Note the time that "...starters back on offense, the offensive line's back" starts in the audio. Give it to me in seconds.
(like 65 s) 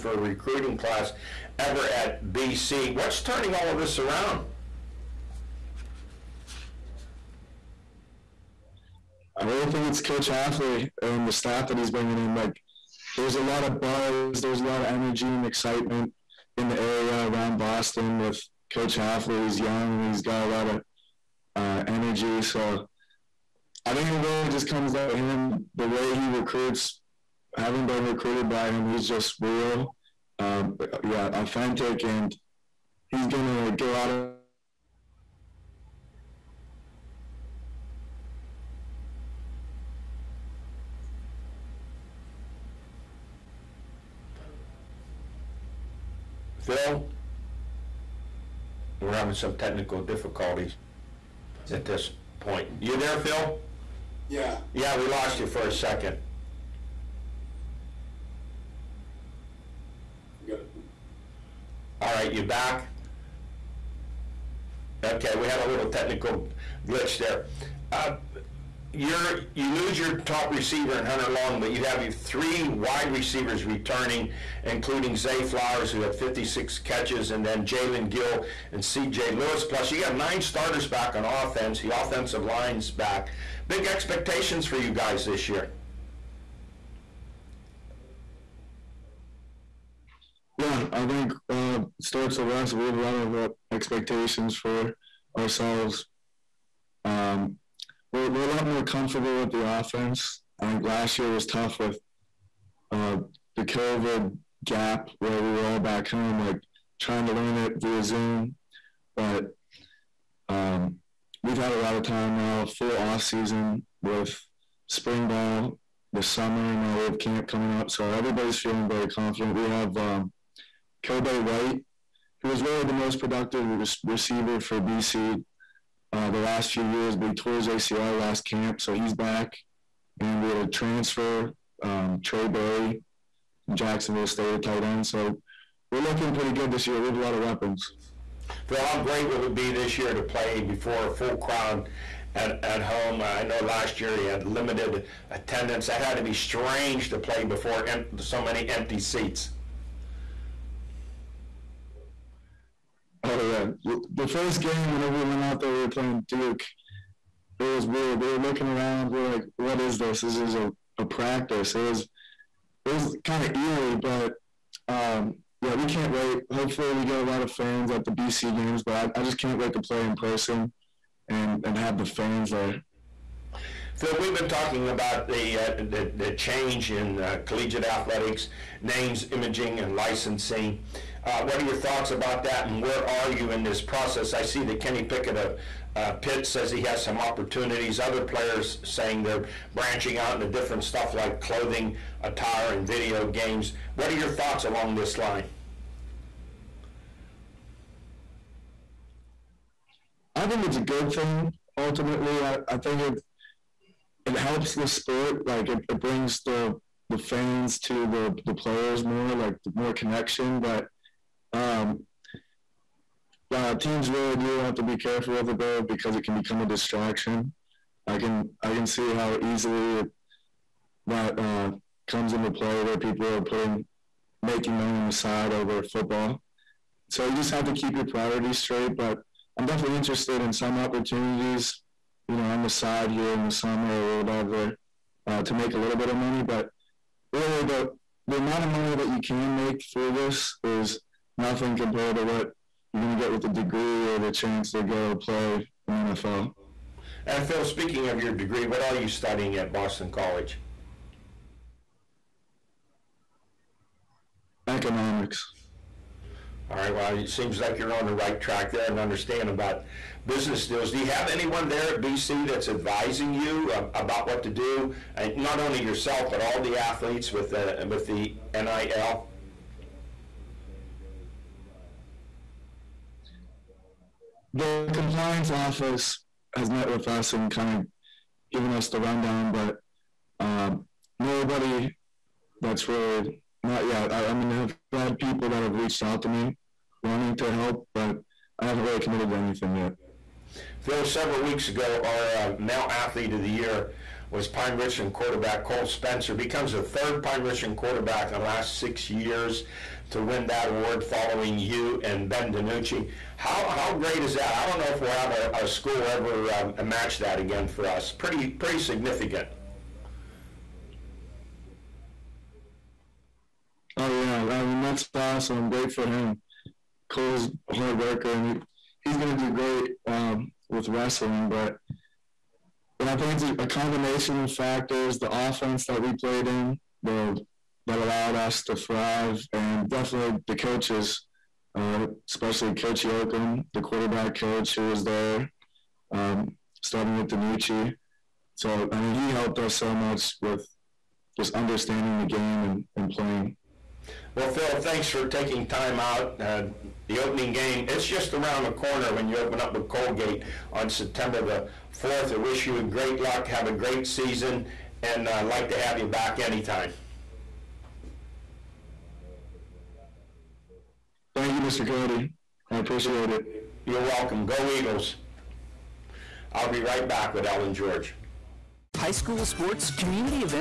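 80 s.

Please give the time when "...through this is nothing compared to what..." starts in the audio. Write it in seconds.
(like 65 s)
239 s.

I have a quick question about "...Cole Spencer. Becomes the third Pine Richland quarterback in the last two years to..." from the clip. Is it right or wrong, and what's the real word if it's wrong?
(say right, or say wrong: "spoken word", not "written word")
wrong: "six", not "two".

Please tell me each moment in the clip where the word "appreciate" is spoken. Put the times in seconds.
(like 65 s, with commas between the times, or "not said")
362 s.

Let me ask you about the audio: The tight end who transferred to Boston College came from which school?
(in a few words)
Jacksonville State.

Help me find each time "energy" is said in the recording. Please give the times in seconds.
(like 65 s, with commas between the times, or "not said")
14 s, 21 s.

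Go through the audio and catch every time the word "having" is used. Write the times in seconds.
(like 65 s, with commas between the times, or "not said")
27 s, 49 s.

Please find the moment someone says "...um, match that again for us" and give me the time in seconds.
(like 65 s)
306 s.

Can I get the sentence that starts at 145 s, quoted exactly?
That had to be strange to play before em- so many empty seats.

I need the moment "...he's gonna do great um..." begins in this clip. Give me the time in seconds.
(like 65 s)
319 s.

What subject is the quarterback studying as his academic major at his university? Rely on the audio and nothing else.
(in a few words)
Economics.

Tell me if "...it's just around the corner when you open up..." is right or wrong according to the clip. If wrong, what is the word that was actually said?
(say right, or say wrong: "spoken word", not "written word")
right.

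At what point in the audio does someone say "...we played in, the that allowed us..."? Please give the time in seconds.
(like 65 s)
325 s.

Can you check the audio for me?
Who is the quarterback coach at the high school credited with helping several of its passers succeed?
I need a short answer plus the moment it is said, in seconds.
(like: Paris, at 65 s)
Coach Yoakum, at 332 s.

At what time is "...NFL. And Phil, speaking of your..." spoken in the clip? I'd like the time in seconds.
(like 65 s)
246 s.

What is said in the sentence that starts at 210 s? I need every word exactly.
But um, uh, teams really do have to be careful with it though, because it can become a distraction.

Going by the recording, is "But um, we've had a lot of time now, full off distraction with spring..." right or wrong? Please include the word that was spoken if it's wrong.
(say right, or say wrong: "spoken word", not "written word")
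wrong: "season", not "distraction".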